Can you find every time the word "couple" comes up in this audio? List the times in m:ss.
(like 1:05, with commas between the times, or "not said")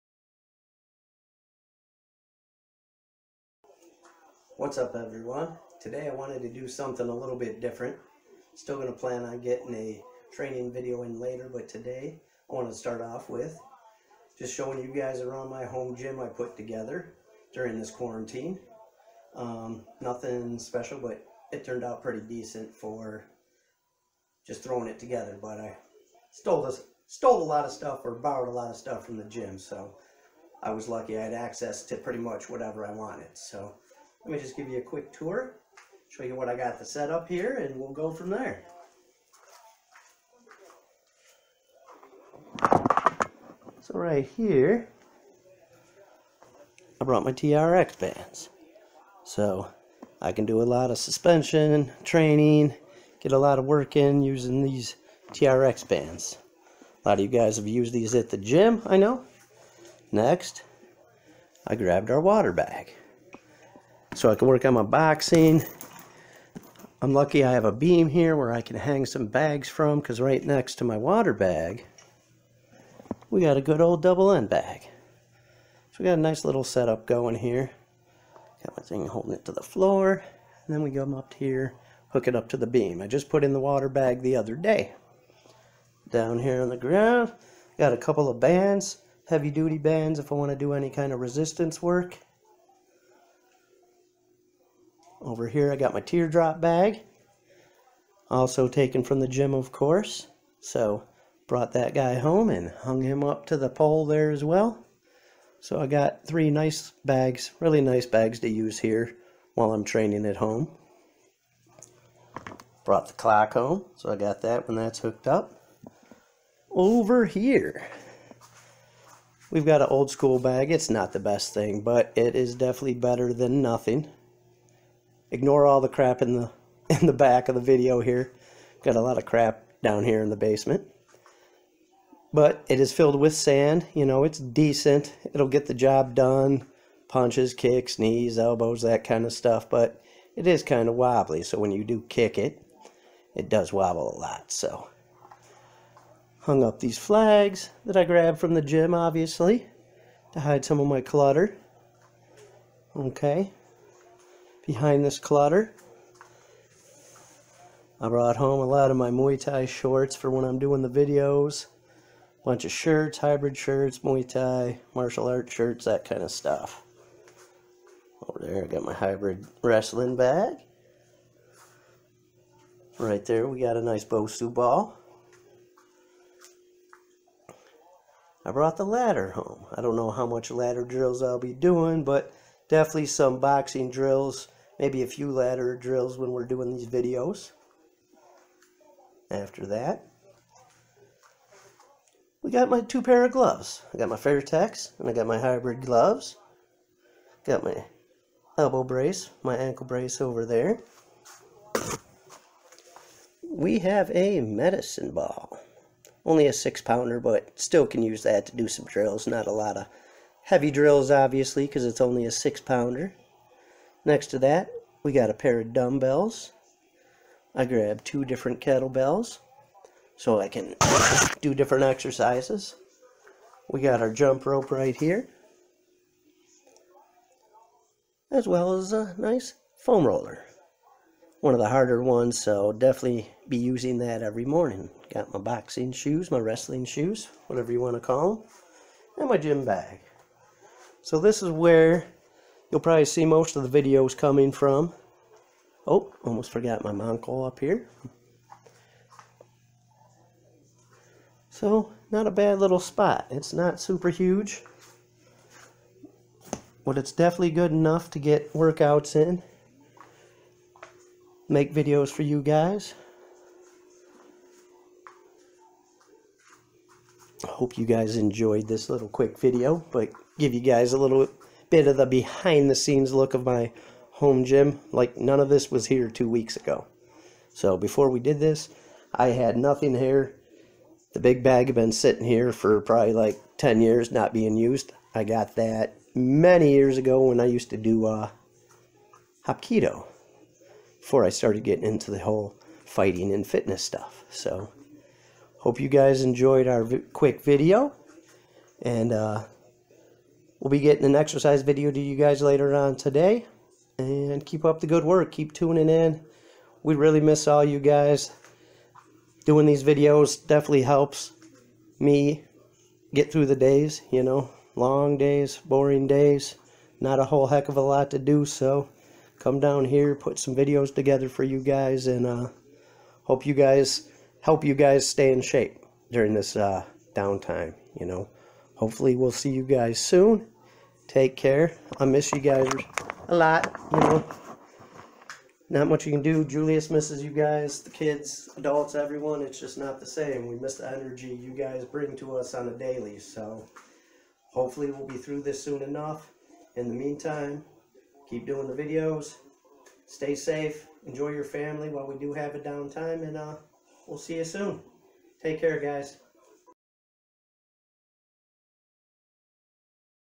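1:27.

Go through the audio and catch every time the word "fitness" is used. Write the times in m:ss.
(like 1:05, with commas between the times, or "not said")
4:53.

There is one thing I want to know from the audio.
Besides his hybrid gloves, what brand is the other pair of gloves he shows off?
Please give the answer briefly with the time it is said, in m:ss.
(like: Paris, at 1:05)
Fairtex, at 3:14.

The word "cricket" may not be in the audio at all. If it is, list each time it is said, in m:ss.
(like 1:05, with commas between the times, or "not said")
not said.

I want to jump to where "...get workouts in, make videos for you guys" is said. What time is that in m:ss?
4:18.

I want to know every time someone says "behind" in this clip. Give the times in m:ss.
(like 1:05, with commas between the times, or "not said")
2:34, 4:32.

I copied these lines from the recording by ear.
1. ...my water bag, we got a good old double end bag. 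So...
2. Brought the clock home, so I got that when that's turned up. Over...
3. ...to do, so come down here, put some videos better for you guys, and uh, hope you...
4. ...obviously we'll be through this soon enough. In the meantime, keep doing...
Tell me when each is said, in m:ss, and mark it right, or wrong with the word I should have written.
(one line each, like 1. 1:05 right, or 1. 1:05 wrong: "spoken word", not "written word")
1. 1:10 right
2. 1:52 wrong: "hooked", not "turned"
3. 5:18 wrong: "together", not "better"
4. 5:44 wrong: "hopefully", not "obviously".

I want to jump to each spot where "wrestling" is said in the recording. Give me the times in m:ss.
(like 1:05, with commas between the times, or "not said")
2:49, 3:56.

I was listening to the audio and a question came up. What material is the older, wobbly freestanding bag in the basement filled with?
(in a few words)
Sand.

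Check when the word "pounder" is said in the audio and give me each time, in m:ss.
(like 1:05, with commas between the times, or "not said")
3:26, 3:32.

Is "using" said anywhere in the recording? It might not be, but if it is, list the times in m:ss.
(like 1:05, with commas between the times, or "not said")
0:54, 3:53.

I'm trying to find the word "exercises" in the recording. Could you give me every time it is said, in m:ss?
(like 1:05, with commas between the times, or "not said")
3:41, 5:01.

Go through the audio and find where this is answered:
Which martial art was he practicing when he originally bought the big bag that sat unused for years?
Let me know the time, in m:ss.
4:49.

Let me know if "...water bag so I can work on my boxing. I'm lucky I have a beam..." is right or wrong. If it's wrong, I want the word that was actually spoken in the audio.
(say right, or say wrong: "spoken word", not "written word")
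right.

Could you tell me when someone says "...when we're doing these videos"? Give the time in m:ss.
3:06.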